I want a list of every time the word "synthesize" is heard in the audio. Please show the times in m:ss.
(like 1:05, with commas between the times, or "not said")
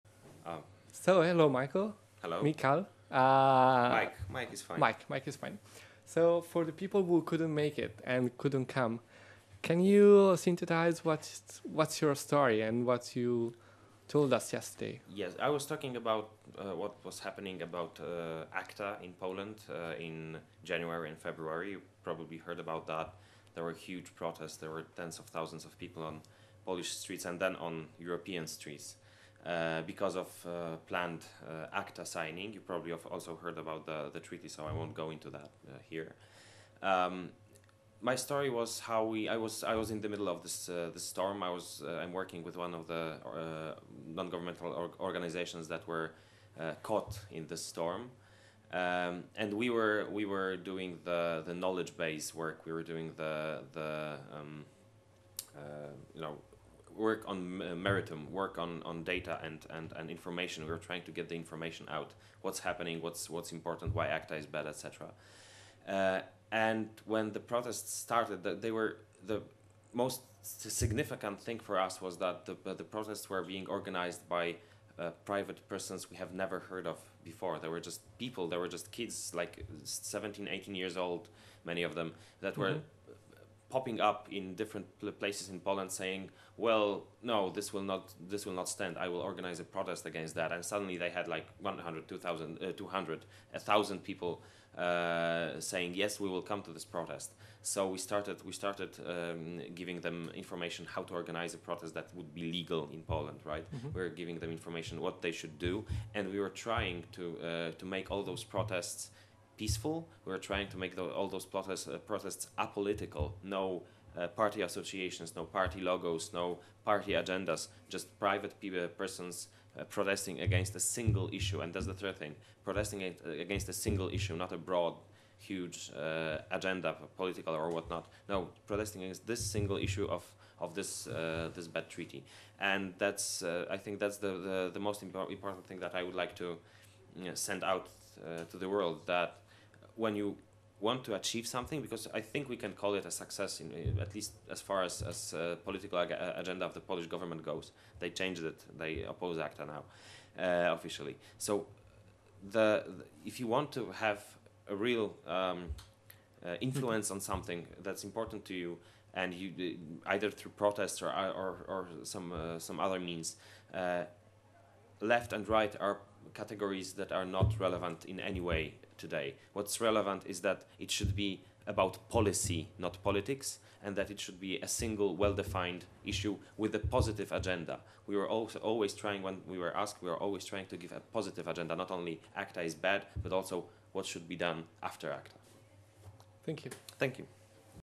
0:10.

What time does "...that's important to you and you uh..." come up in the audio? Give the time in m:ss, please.
2:37.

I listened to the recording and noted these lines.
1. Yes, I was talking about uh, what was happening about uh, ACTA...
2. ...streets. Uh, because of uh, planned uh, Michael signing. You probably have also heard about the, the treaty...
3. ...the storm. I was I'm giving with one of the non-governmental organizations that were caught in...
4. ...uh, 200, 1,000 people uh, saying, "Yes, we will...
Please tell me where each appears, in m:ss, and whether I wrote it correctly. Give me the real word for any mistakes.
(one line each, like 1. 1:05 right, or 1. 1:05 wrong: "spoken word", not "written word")
1. 0:15 right
2. 0:28 wrong: "ACTA", not "Michael"
3. 0:40 wrong: "working", not "giving"
4. 1:32 right.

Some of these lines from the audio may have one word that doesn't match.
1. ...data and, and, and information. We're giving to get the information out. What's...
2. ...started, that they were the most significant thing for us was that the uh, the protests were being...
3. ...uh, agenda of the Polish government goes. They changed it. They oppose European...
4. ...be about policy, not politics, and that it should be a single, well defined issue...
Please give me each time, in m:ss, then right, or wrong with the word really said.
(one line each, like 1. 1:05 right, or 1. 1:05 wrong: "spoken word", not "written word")
1. 0:59 wrong: "trying", not "giving"
2. 1:07 right
3. 2:26 wrong: "ACTA", not "European"
4. 2:51 right.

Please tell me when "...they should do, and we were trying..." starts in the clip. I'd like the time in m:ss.
1:45.